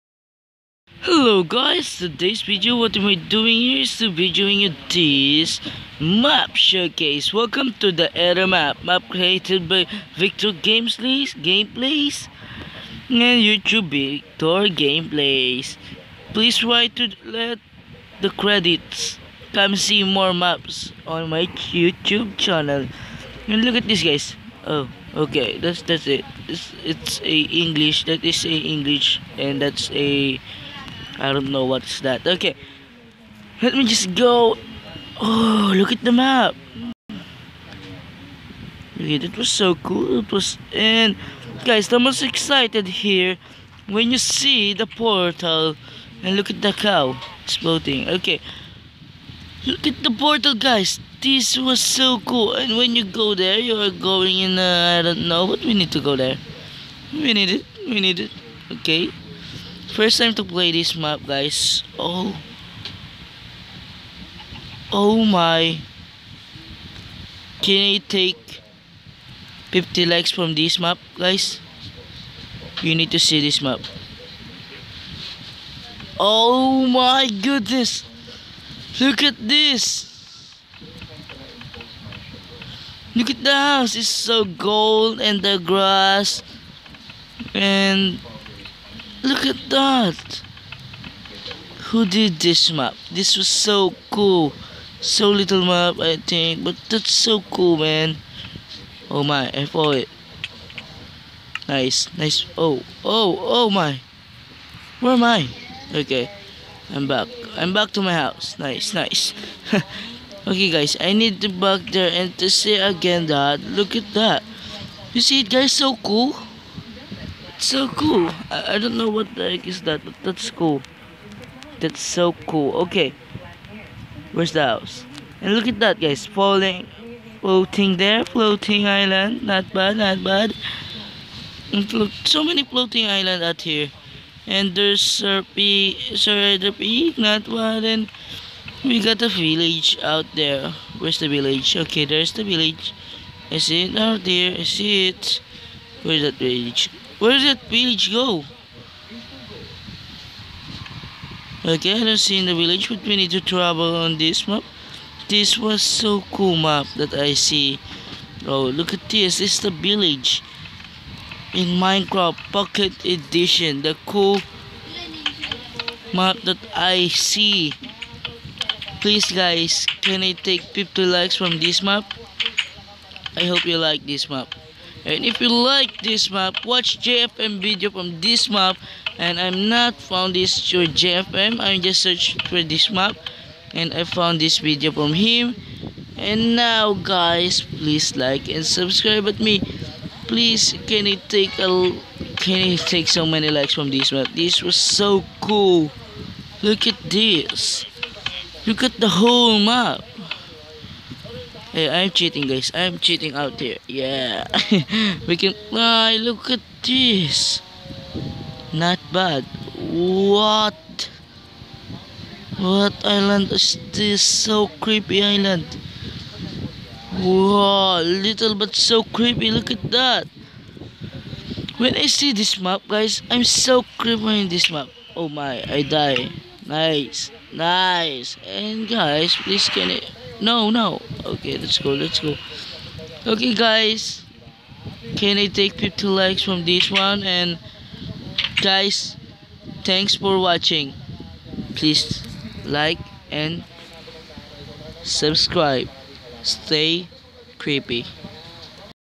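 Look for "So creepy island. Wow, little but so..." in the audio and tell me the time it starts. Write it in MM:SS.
03:34.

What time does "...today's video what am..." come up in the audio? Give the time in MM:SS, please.
00:01.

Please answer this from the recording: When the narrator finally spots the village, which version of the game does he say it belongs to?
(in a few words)
Minecraft Pocket Edition.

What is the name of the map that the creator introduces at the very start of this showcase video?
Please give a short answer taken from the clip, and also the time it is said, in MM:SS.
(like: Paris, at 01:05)
Era, at 00:08.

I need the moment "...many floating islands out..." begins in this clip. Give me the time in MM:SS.
02:12.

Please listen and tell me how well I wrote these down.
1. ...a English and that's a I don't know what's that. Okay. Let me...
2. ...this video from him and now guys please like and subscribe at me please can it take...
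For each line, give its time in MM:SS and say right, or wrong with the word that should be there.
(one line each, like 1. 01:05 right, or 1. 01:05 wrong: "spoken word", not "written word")
1. 00:28 right
2. 03:04 right.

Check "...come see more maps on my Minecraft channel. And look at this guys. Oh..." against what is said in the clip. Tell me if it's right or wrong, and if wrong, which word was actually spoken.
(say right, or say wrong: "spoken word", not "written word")
wrong: "YouTube", not "Minecraft".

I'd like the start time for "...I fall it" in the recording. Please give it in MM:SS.
01:39.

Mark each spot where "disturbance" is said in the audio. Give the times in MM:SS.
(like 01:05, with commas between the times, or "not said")
not said.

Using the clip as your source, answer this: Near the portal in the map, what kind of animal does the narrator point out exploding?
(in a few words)
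Cow.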